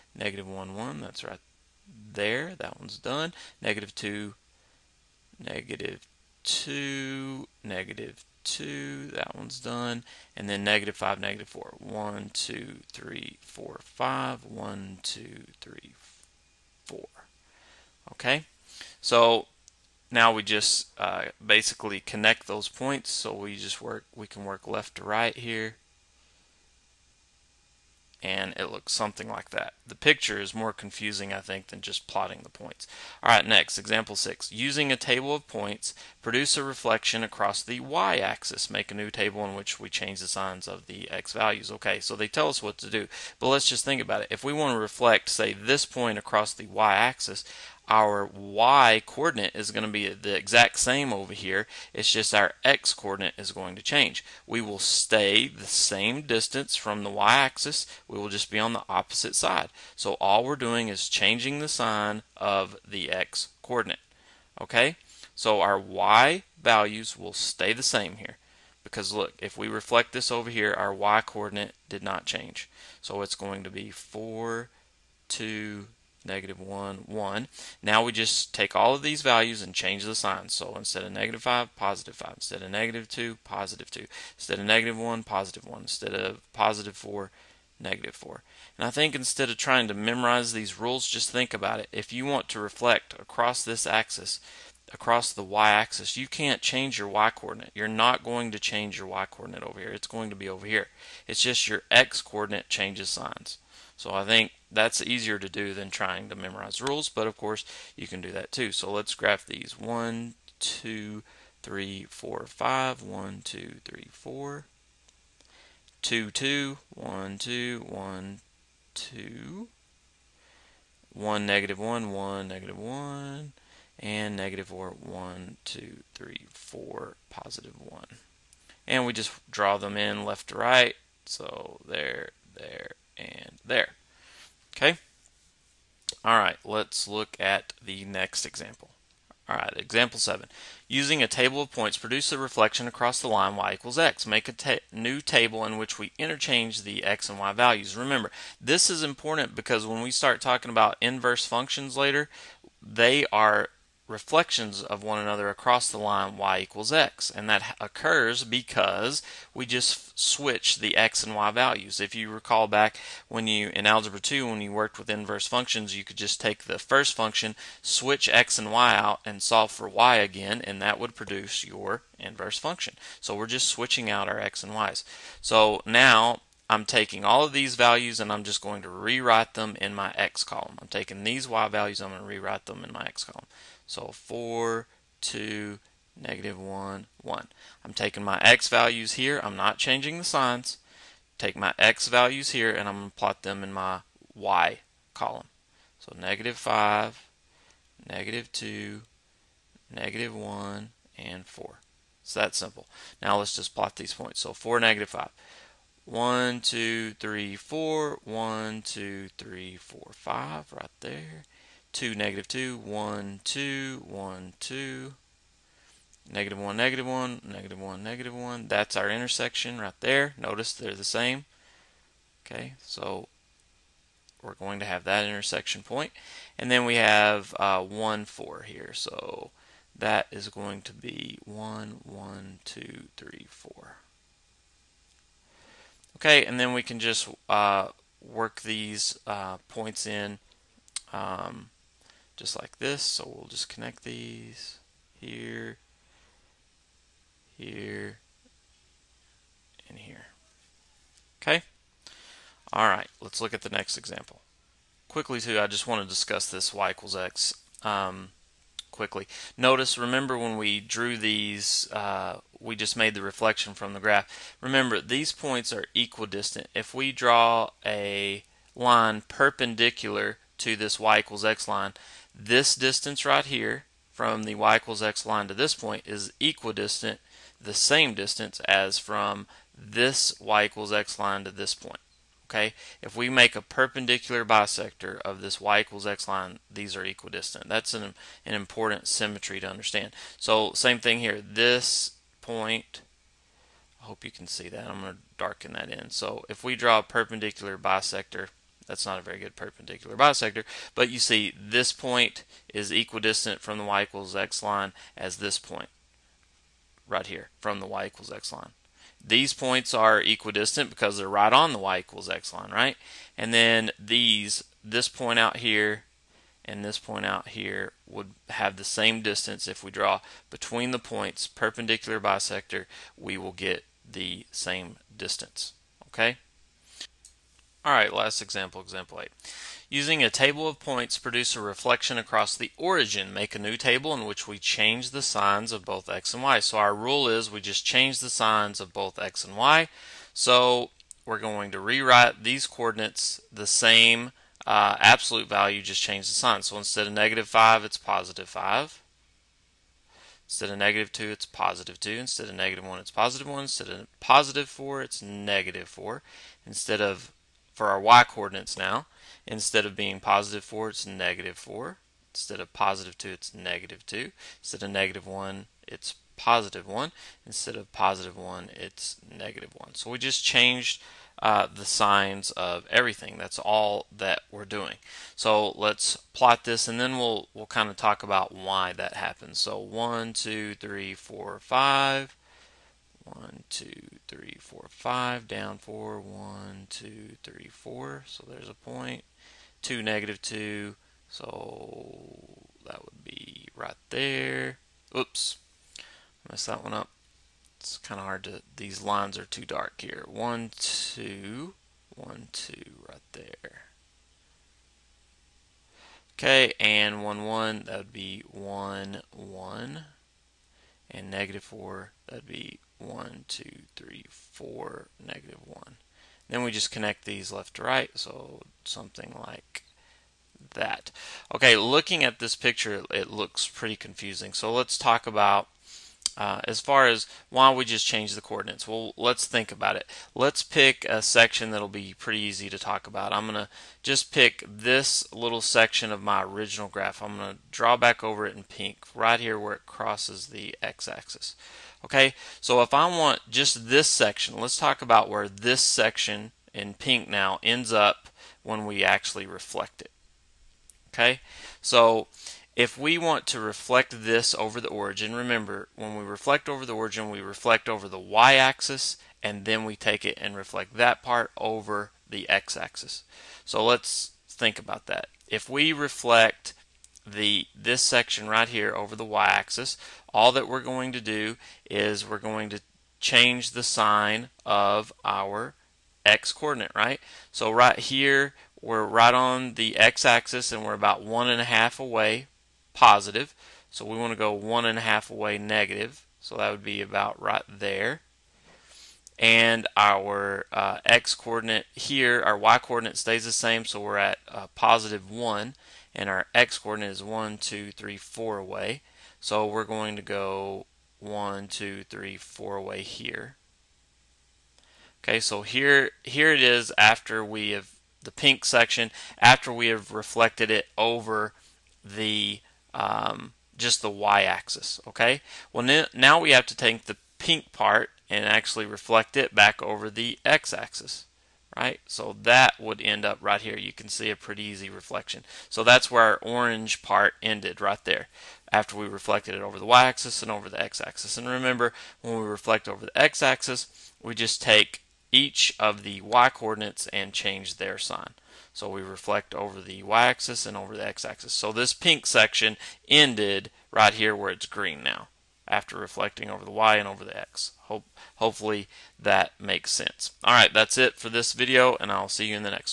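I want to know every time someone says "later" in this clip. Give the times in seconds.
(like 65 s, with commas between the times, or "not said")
151 s.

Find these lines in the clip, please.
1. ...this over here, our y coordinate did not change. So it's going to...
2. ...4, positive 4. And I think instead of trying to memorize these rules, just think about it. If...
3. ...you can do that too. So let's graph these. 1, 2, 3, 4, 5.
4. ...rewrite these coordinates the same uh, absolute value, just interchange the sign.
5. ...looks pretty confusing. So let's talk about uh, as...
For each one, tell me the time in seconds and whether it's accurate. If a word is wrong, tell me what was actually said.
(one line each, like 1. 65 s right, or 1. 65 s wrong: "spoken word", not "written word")
1. 70 s right
2. 86 s wrong: "negative", not "positive"
3. 107 s right
4. 341 s wrong: "change", not "interchange"
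5. 423 s right.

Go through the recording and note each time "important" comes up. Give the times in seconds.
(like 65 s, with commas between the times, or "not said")
149 s, 288 s.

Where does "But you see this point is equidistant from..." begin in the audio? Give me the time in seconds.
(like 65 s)
300 s.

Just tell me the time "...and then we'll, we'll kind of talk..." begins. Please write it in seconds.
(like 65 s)
376 s.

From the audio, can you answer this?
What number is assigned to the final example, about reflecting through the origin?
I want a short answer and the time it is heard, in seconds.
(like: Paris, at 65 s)
8, at 328 s.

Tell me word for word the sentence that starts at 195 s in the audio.
So negative 5, negative 2, negative 1, and 4.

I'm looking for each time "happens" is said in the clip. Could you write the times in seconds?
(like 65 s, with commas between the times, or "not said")
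379 s.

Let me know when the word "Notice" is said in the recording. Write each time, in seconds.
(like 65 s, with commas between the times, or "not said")
220 s, 259 s.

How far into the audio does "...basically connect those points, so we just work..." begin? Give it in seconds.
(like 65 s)
21 s.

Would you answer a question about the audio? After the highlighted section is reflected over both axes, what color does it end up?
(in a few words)
green.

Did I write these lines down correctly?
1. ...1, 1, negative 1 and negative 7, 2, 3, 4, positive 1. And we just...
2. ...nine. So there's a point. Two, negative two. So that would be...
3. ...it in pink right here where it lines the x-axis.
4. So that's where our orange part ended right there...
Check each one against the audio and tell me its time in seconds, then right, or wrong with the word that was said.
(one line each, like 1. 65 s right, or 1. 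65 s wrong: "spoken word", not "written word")
1. 121 s wrong: "1", not "7"
2. 387 s wrong: "four", not "nine"
3. 438 s wrong: "crosses", not "lines"
4. 525 s right.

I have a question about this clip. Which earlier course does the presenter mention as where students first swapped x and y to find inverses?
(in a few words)
Algebra 2.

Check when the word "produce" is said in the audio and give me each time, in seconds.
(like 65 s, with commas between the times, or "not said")
36 s, 141 s, 171 s, 331 s.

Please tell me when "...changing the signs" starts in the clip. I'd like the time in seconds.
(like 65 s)
189 s.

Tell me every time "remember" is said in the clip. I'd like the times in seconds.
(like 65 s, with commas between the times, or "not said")
147 s, 259 s, 264 s, 455 s, 531 s.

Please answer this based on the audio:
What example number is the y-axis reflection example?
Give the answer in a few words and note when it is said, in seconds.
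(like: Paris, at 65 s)
6, at 33 s.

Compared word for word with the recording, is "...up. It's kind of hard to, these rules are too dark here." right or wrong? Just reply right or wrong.
wrong.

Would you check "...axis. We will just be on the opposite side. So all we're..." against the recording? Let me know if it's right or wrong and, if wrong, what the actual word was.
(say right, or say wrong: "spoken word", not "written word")
right.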